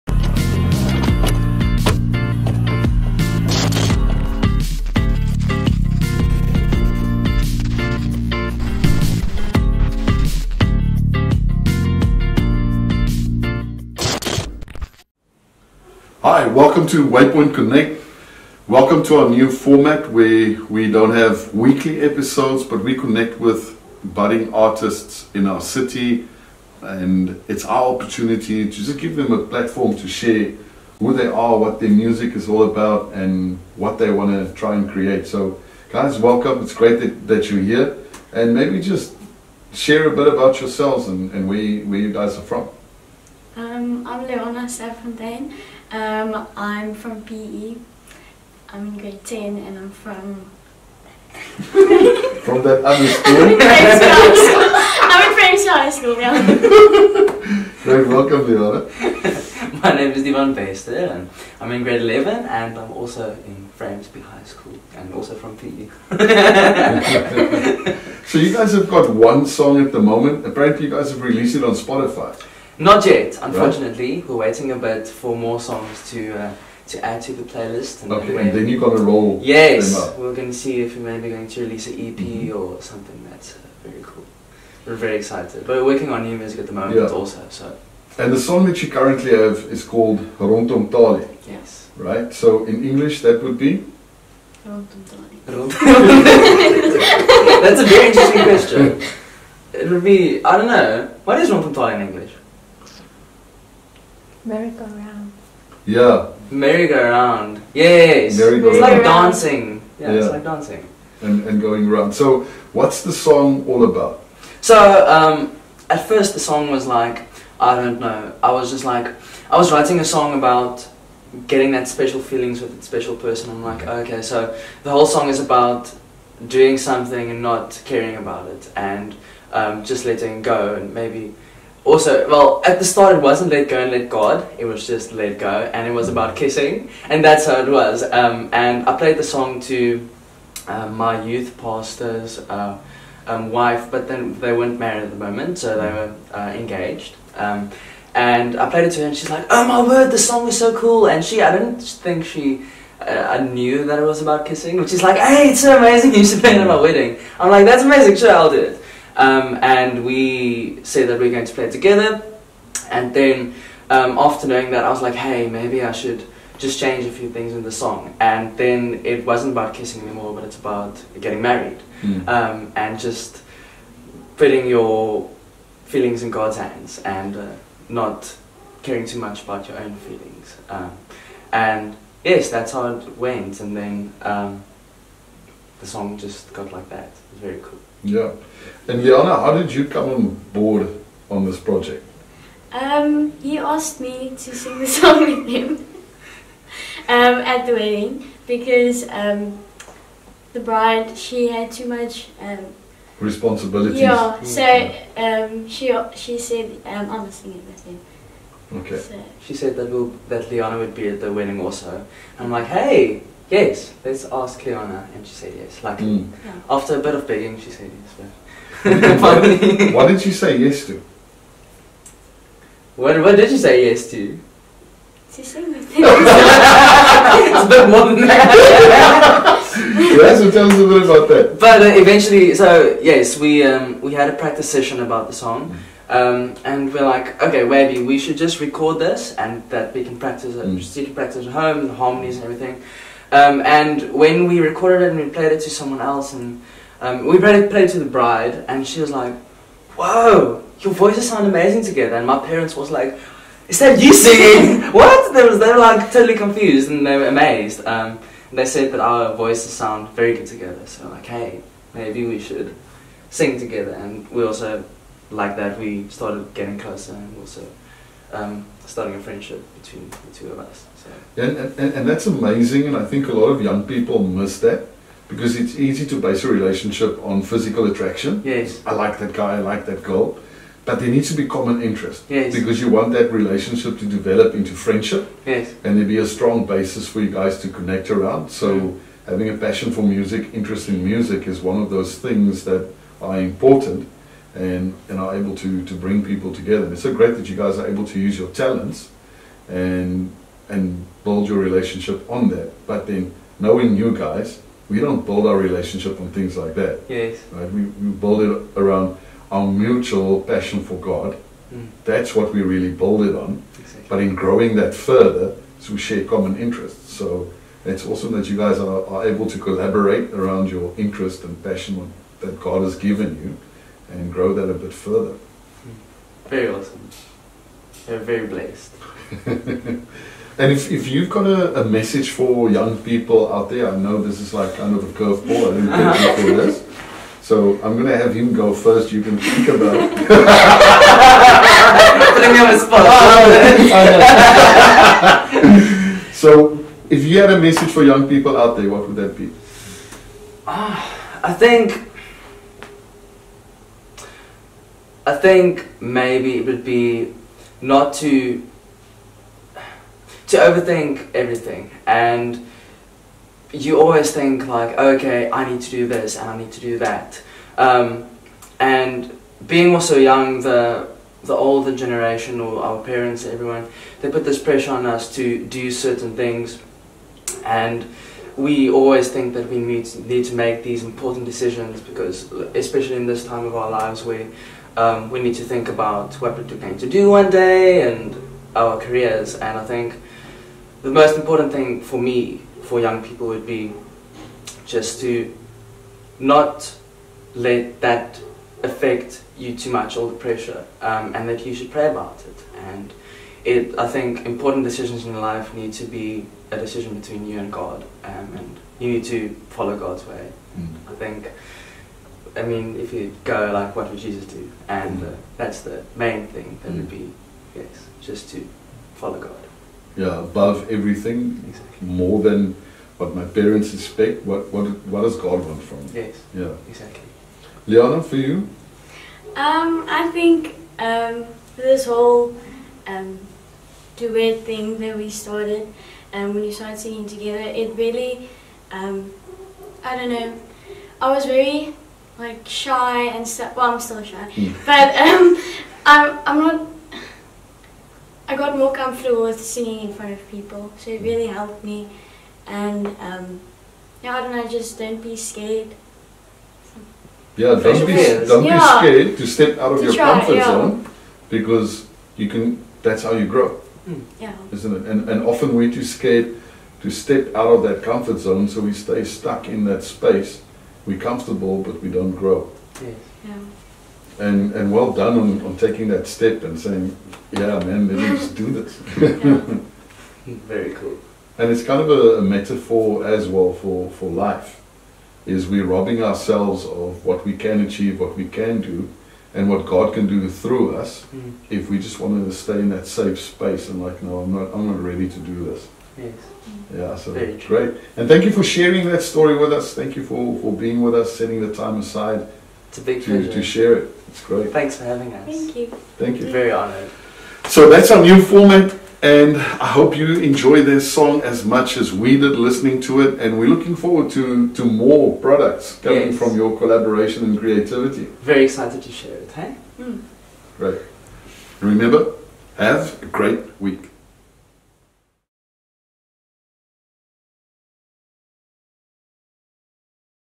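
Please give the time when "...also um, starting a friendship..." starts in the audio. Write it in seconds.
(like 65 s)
267 s.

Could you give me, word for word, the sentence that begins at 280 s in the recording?
But there needs to be common interest.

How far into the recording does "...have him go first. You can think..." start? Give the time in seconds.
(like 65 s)
338 s.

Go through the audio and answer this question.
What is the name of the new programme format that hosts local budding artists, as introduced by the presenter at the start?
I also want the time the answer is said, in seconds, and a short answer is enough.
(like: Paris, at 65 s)
Waypoint Connect, at 17 s.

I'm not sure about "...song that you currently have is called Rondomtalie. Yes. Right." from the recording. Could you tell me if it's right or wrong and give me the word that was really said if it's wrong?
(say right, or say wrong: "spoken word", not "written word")
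right.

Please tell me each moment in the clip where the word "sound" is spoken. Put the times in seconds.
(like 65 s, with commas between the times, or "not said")
251 s, 259 s.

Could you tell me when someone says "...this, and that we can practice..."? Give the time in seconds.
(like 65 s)
238 s.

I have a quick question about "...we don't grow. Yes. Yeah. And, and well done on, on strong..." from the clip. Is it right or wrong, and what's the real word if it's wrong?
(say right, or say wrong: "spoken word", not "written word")
wrong: "taking", not "strong".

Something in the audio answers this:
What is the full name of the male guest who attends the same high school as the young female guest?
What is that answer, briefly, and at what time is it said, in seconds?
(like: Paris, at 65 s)
Divan Bester, at 60 s.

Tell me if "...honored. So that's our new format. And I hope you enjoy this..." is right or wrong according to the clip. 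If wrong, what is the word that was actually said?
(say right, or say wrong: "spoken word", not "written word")
right.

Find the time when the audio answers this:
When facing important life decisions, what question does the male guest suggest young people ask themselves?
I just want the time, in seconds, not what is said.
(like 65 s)
413 s.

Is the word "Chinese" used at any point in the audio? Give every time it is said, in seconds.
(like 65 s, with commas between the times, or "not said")
not said.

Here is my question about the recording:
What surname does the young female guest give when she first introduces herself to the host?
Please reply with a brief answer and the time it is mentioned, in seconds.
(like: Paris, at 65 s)
Safontaine, at 44 s.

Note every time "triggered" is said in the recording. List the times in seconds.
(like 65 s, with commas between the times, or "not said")
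not said.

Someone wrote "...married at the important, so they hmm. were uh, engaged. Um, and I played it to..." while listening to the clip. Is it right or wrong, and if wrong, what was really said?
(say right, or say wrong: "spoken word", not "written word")
wrong: "moment", not "important".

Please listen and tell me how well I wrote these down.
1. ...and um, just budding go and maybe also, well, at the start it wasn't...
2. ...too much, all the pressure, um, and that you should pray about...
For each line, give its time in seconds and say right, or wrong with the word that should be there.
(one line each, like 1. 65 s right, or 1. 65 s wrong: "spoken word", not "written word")
1. 128 s wrong: "letting", not "budding"
2. 399 s right.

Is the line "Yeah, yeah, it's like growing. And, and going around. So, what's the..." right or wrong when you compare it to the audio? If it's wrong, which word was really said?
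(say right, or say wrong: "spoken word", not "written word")
wrong: "dancing", not "growing".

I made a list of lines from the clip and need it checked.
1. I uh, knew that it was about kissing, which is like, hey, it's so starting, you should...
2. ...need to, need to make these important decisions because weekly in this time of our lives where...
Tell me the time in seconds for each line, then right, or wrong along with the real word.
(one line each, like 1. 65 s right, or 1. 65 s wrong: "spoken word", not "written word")
1. 152 s wrong: "amazing", not "starting"
2. 379 s wrong: "especially", not "weekly".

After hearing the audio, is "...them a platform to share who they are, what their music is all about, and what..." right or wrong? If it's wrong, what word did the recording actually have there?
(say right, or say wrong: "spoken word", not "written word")
right.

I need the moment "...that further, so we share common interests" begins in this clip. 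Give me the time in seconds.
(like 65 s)
314 s.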